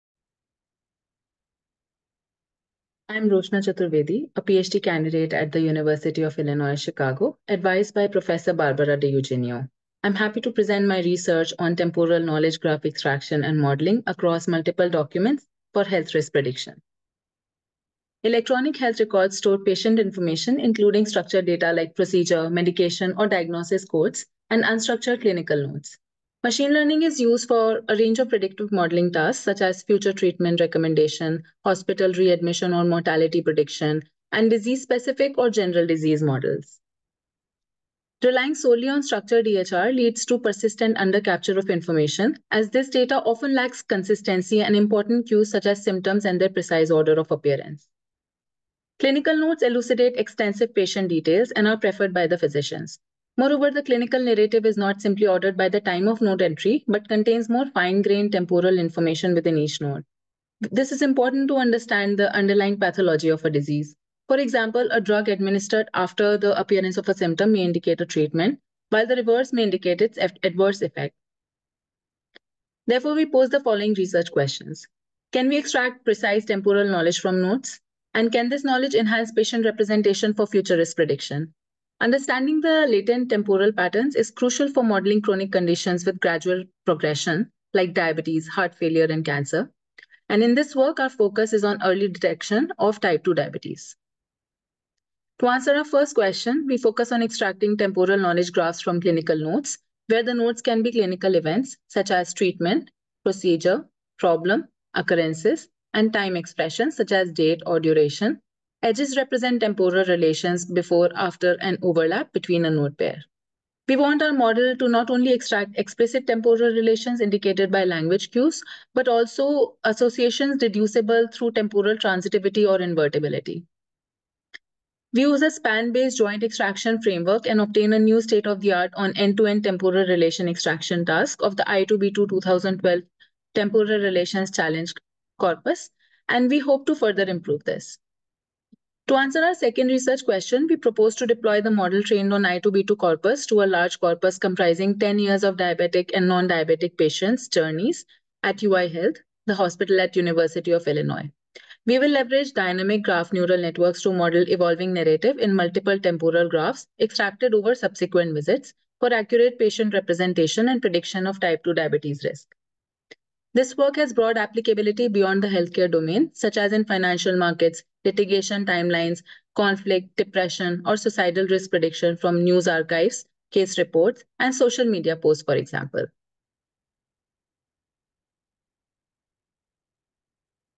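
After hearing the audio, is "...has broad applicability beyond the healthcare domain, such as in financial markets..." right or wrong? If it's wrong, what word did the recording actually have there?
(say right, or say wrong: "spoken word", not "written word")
right.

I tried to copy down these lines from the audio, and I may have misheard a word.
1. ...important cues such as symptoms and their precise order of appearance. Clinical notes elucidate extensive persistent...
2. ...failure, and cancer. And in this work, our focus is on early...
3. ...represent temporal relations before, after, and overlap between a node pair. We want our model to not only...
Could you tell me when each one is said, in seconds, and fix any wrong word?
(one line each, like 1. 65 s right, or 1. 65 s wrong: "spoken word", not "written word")
1. 44 s wrong: "patient", not "persistent"
2. 88 s right
3. 109 s right.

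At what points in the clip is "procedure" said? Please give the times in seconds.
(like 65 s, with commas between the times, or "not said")
21 s, 103 s.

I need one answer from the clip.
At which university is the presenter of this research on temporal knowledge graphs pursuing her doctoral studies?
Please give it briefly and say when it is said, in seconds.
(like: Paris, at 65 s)
University of Illinois Chicago, at 5 s.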